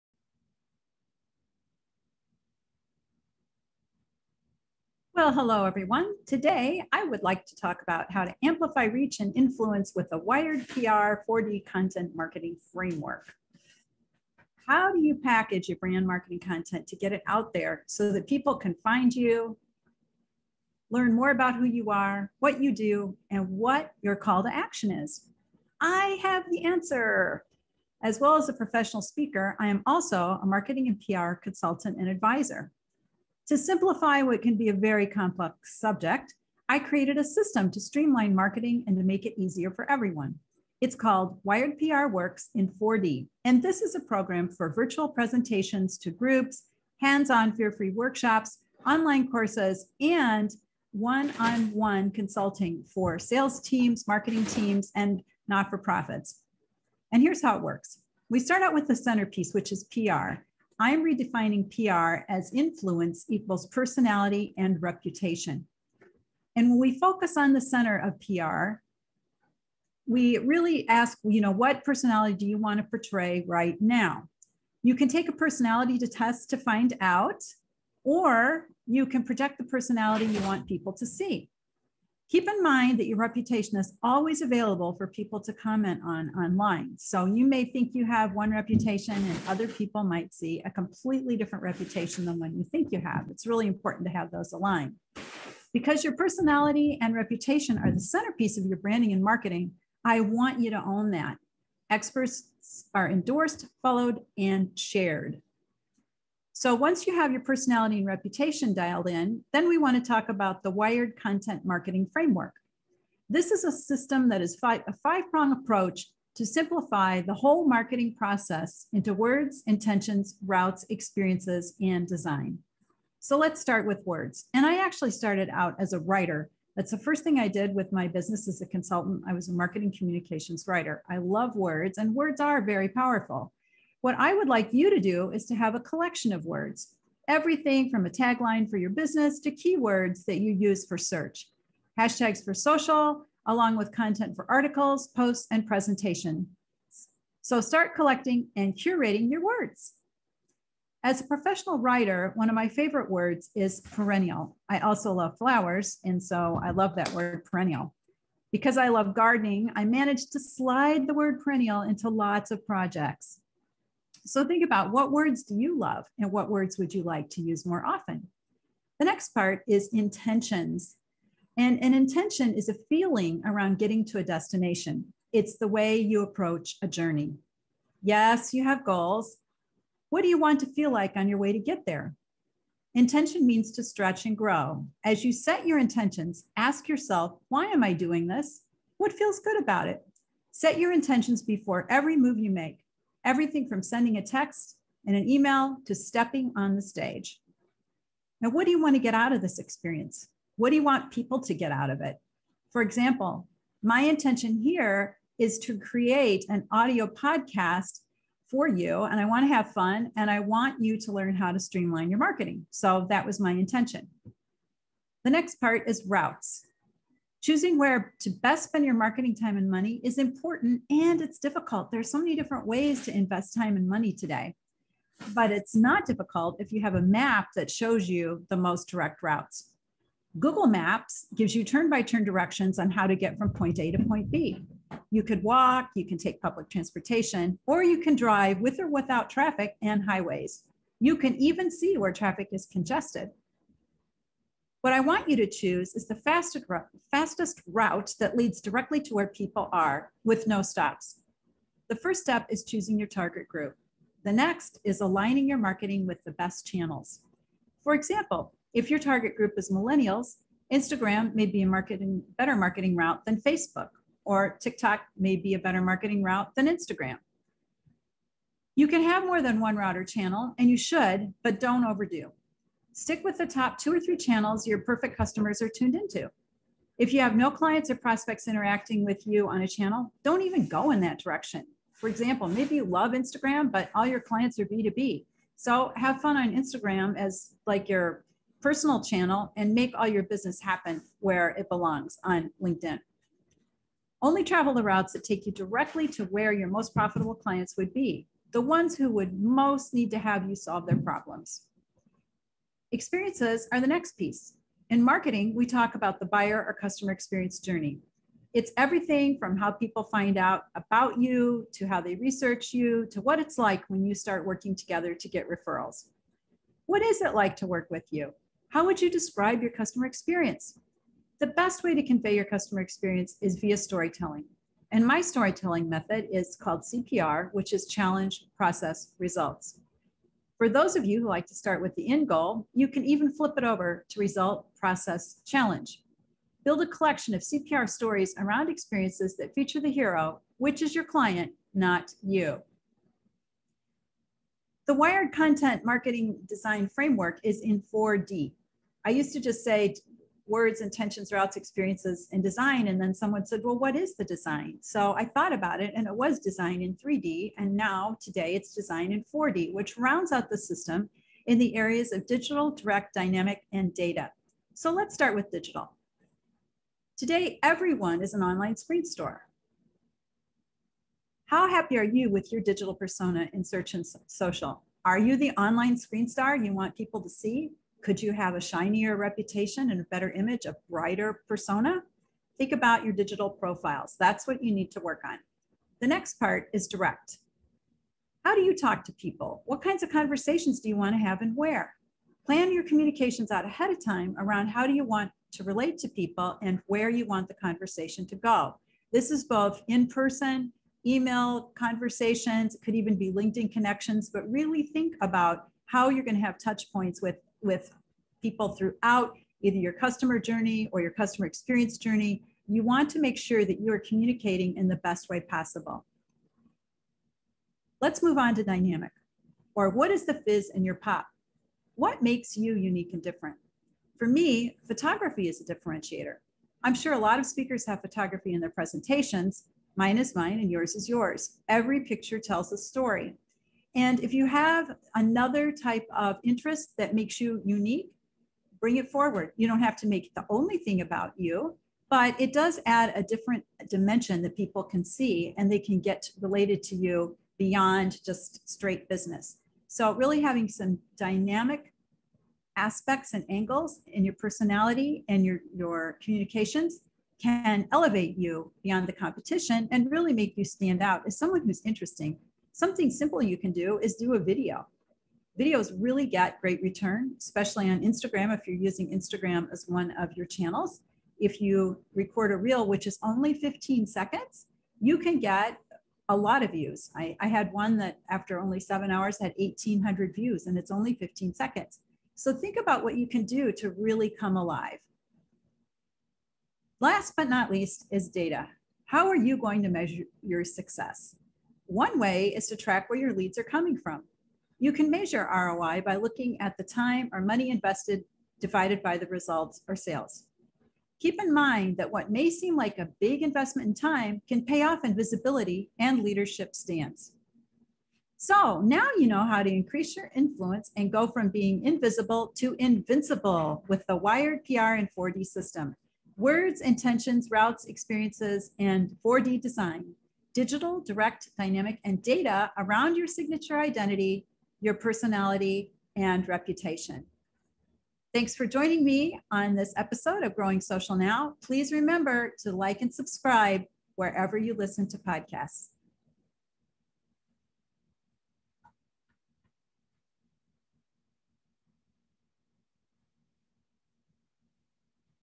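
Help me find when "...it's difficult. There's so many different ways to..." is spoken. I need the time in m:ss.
3:41.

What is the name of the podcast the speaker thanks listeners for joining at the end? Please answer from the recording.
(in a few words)
Growing Social Now.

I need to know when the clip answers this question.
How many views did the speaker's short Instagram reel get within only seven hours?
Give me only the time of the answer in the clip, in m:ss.
7:59.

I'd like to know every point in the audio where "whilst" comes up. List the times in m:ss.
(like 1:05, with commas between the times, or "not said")
not said.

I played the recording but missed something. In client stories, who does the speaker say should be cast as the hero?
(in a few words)
Your client.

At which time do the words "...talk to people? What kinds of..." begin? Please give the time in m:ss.
6:28.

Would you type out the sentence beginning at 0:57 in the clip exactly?
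And here's how it works we start out with the centerpiece, which is PR.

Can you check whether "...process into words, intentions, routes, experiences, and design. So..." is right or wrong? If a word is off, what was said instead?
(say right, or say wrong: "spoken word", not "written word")
right.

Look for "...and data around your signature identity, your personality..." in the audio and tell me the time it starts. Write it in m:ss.
8:42.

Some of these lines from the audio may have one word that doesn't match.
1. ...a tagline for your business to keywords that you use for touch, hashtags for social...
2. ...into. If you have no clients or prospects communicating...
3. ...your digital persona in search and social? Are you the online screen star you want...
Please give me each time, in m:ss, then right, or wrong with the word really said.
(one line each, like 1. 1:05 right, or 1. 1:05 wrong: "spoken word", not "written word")
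1. 2:18 wrong: "search", not "touch"
2. 4:35 wrong: "interacting", not "communicating"
3. 6:12 right.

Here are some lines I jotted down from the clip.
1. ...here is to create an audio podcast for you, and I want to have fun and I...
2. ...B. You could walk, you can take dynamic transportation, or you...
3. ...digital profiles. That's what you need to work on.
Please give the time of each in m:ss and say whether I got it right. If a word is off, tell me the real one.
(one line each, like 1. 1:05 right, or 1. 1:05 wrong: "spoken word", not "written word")
1. 3:24 right
2. 3:54 wrong: "public", not "dynamic"
3. 6:23 right.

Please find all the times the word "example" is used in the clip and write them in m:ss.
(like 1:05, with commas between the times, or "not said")
3:22, 4:17, 4:42.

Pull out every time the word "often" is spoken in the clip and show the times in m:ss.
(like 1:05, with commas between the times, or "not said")
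2:47.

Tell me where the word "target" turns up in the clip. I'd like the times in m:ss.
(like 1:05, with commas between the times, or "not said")
4:13, 4:18.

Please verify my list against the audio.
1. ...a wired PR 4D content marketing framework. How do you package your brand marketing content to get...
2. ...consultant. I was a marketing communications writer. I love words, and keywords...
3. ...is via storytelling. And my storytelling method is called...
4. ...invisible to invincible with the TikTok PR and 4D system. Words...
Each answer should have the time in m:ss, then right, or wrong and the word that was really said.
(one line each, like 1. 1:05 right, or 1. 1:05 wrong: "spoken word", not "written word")
1. 0:10 right
2. 2:08 wrong: "words", not "keywords"
3. 5:23 right
4. 8:31 wrong: "Wired", not "TikTok".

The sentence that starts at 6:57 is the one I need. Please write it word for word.
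Let's move on to dynamic, or what is the fizz in your pop?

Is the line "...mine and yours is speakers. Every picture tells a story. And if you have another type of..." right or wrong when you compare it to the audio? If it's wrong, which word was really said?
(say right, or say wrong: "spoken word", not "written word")
wrong: "yours", not "speakers".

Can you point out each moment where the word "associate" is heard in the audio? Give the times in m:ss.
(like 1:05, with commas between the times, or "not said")
not said.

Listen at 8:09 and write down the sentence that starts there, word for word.
How are you going to measure your success?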